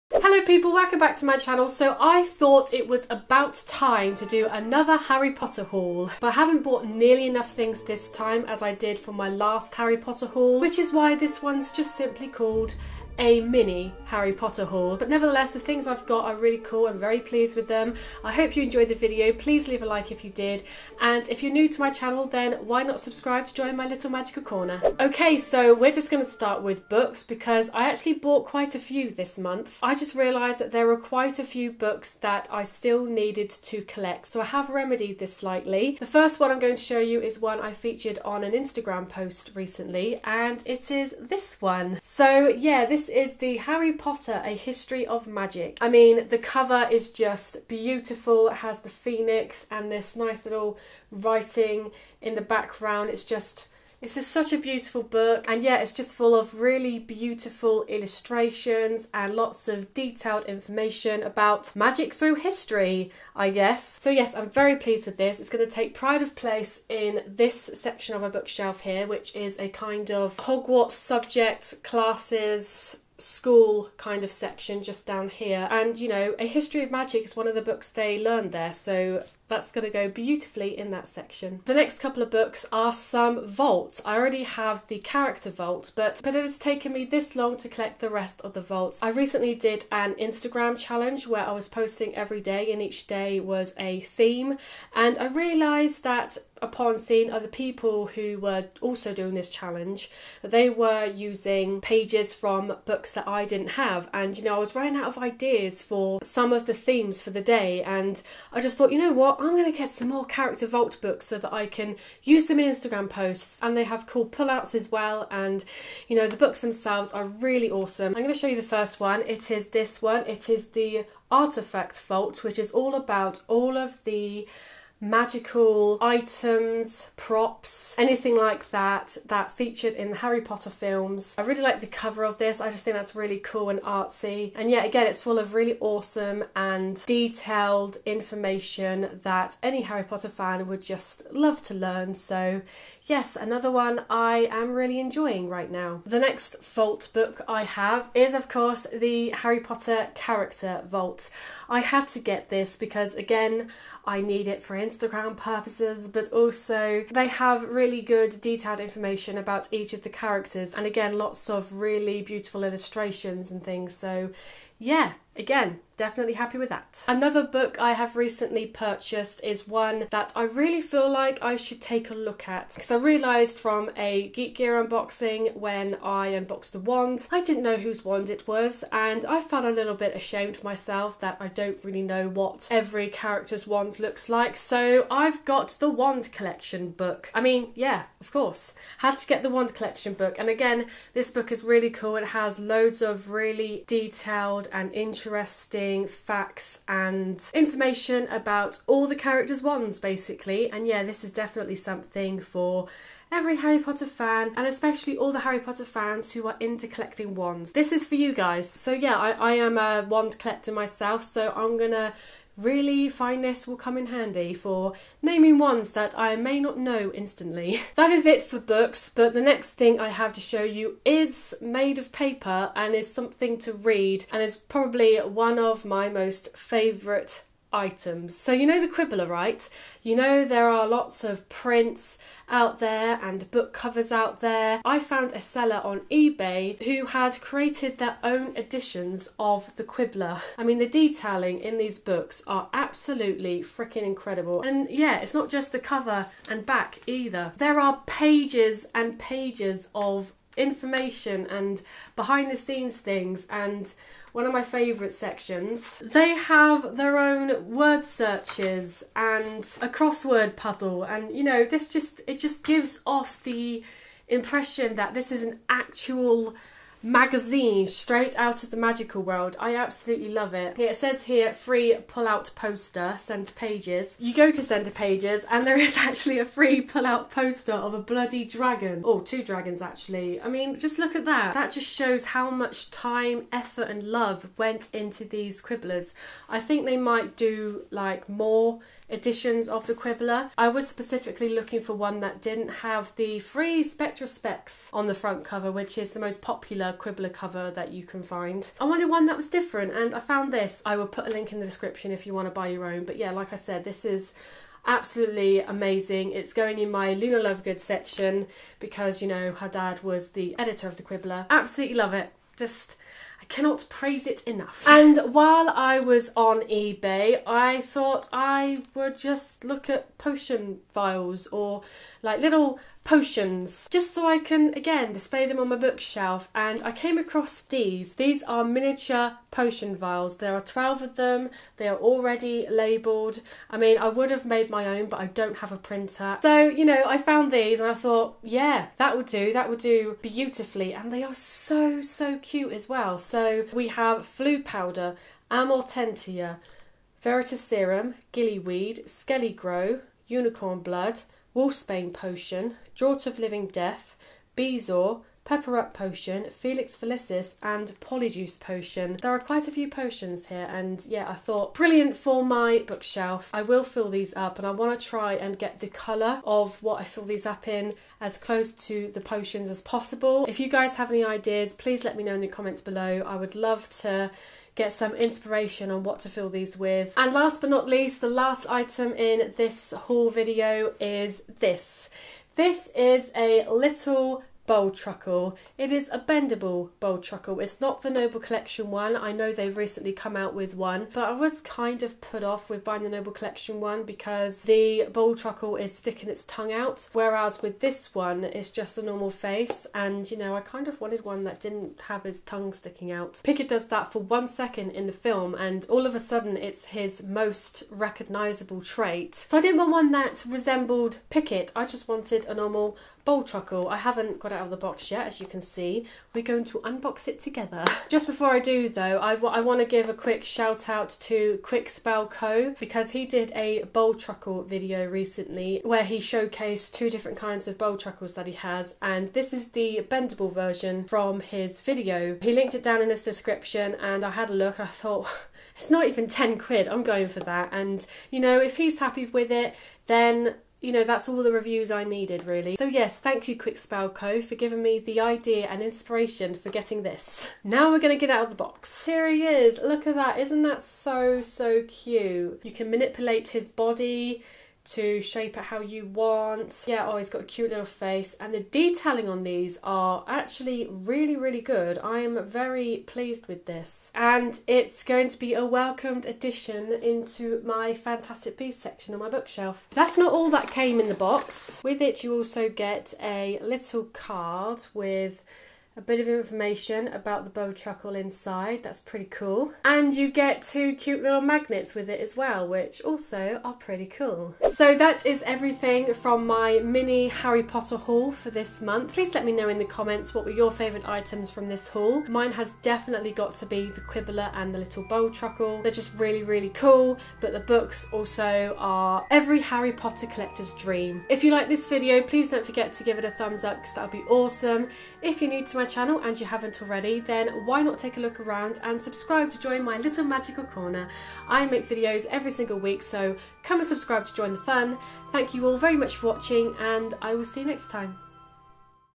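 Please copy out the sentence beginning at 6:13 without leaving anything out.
I would love to get some inspiration on what to fill these with.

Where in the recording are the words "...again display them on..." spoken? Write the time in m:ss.
5:24.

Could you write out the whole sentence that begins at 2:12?
I just think that's really cool and artsy.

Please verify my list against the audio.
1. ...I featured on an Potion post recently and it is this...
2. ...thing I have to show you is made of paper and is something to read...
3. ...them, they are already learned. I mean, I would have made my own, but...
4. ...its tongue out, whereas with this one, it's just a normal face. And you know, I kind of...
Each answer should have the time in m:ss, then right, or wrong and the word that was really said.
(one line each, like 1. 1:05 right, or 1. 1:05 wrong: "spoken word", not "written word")
1. 0:37 wrong: "Instagram", not "Potion"
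2. 3:39 right
3. 5:31 wrong: "labelled", not "learned"
4. 6:36 right.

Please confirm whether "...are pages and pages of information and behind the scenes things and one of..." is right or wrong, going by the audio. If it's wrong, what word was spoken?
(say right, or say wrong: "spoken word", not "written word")
right.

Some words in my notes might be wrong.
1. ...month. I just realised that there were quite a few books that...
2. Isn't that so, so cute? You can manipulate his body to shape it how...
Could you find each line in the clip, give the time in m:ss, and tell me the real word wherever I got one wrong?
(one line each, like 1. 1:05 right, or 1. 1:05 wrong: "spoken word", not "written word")
1. 0:29 right
2. 7:30 right.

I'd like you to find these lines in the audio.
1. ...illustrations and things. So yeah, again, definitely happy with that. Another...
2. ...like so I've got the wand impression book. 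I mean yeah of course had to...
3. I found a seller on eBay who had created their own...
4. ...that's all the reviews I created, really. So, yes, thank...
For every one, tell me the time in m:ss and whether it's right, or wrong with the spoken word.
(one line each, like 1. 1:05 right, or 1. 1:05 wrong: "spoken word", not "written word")
1. 2:42 right
2. 3:04 wrong: "collection", not "impression"
3. 3:54 right
4. 7:21 wrong: "needed", not "created".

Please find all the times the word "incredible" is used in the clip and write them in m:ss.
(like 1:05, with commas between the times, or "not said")
4:04.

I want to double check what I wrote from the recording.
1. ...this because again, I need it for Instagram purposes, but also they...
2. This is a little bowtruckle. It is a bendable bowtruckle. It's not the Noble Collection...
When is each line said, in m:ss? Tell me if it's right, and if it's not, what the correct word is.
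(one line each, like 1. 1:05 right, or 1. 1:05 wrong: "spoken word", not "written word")
1. 2:32 right
2. 6:22 right.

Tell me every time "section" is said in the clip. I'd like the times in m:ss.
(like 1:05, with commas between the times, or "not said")
1:07, 1:14, 1:21, 4:15, 5:07, 7:48.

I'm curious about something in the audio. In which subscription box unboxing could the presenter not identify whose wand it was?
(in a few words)
Geek Gear.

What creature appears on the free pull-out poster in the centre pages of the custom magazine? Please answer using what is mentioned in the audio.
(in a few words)
Dragon.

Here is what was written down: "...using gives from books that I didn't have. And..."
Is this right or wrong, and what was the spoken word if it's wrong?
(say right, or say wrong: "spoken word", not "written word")
wrong: "pages", not "gives".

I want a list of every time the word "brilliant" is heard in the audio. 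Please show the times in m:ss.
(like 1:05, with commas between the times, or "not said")
6:01.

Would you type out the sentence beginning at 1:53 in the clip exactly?
And they have cool pullouts as well.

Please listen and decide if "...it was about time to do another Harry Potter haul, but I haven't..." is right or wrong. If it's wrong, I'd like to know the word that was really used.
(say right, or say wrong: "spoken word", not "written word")
right.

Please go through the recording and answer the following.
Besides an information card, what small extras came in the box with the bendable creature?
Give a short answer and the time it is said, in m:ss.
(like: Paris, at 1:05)
Magnets, at 8:01.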